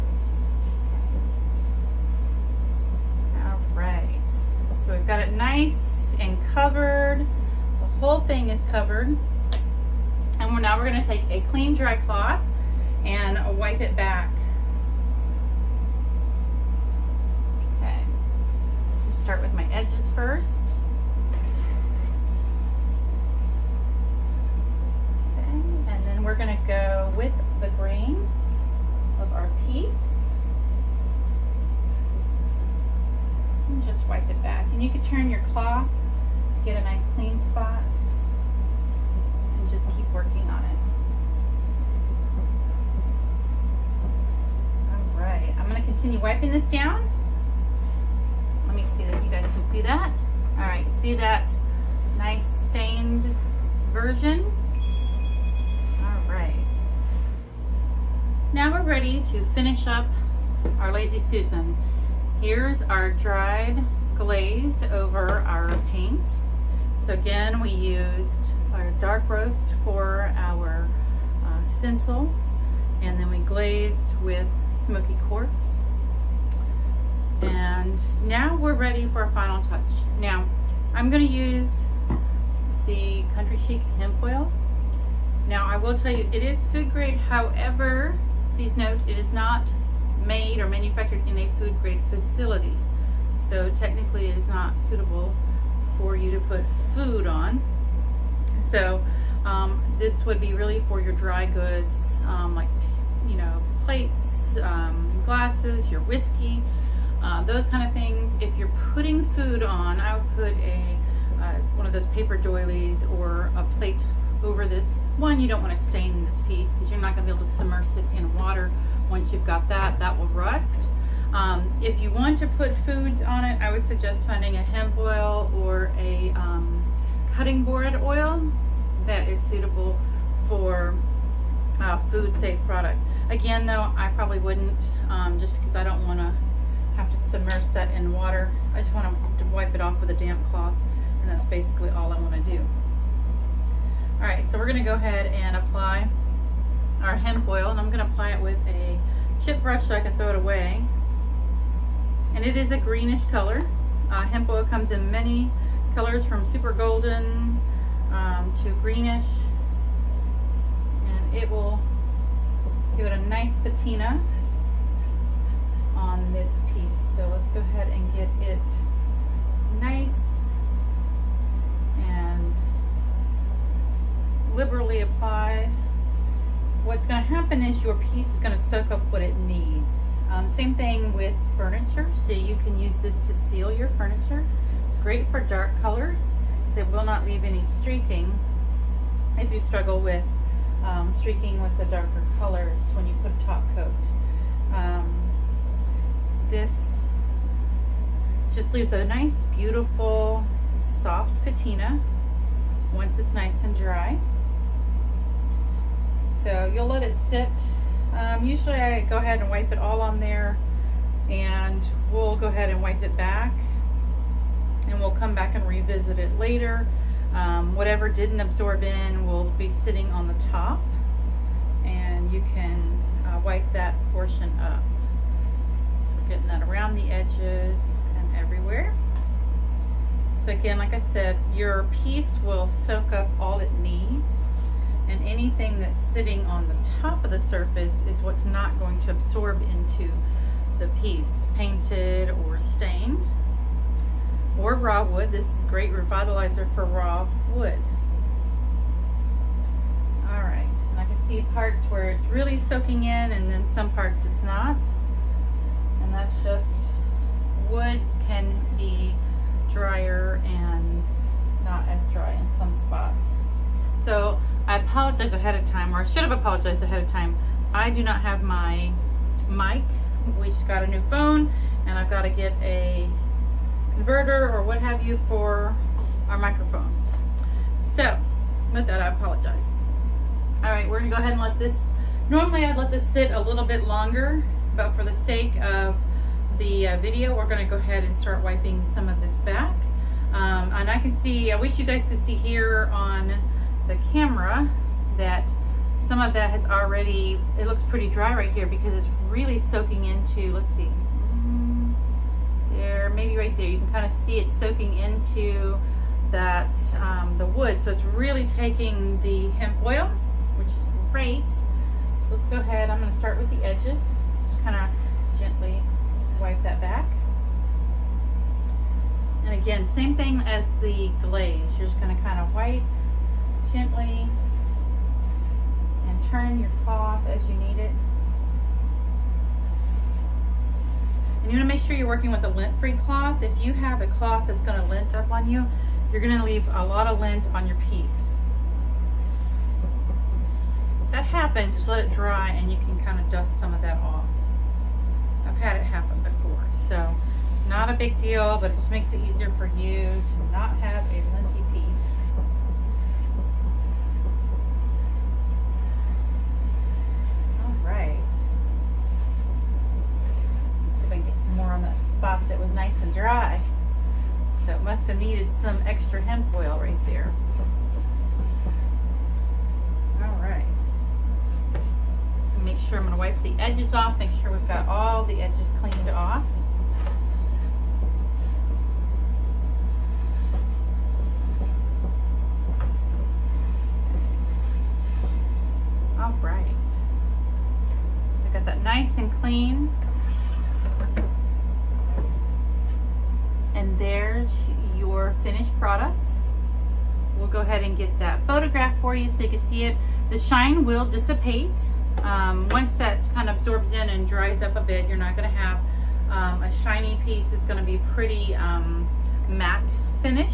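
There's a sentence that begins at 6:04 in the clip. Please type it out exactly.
So it must have needed some extra hemp oil right there.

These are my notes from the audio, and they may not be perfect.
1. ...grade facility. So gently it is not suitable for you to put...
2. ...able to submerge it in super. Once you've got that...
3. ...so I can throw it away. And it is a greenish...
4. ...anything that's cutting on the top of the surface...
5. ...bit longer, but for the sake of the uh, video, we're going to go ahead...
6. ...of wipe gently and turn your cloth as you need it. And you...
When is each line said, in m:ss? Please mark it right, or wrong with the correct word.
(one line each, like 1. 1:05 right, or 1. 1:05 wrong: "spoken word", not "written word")
1. 1:31 wrong: "technically", not "gently"
2. 1:57 wrong: "water", not "super"
3. 2:29 right
4. 3:55 wrong: "sitting", not "cutting"
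5. 4:43 right
6. 5:22 right.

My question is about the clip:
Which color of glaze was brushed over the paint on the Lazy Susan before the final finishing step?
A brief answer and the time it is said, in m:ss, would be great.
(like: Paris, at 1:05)
smoky quartz, at 1:14.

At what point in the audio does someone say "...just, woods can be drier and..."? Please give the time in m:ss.
4:16.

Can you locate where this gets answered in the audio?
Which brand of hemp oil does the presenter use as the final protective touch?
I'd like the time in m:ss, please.
1:23.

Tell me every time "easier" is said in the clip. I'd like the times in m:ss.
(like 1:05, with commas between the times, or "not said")
5:49.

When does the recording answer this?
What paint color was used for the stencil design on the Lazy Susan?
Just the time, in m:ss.
1:08.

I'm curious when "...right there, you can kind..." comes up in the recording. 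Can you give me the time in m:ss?
5:03.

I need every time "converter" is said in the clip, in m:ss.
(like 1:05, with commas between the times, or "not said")
4:33.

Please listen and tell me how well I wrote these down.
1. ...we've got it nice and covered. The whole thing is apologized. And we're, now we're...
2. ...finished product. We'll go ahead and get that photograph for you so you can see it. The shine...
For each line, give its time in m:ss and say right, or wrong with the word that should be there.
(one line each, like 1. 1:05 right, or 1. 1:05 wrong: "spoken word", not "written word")
1. 0:04 wrong: "covered", not "apologized"
2. 6:35 right.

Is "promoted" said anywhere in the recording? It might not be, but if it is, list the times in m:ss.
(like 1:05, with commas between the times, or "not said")
not said.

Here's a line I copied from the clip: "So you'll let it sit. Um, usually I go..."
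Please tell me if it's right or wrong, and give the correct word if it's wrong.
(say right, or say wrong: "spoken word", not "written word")
right.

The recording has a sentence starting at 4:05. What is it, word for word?
This is great revitalizer for raw wood.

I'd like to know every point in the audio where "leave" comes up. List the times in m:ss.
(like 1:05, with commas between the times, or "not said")
3:07, 3:18, 5:36.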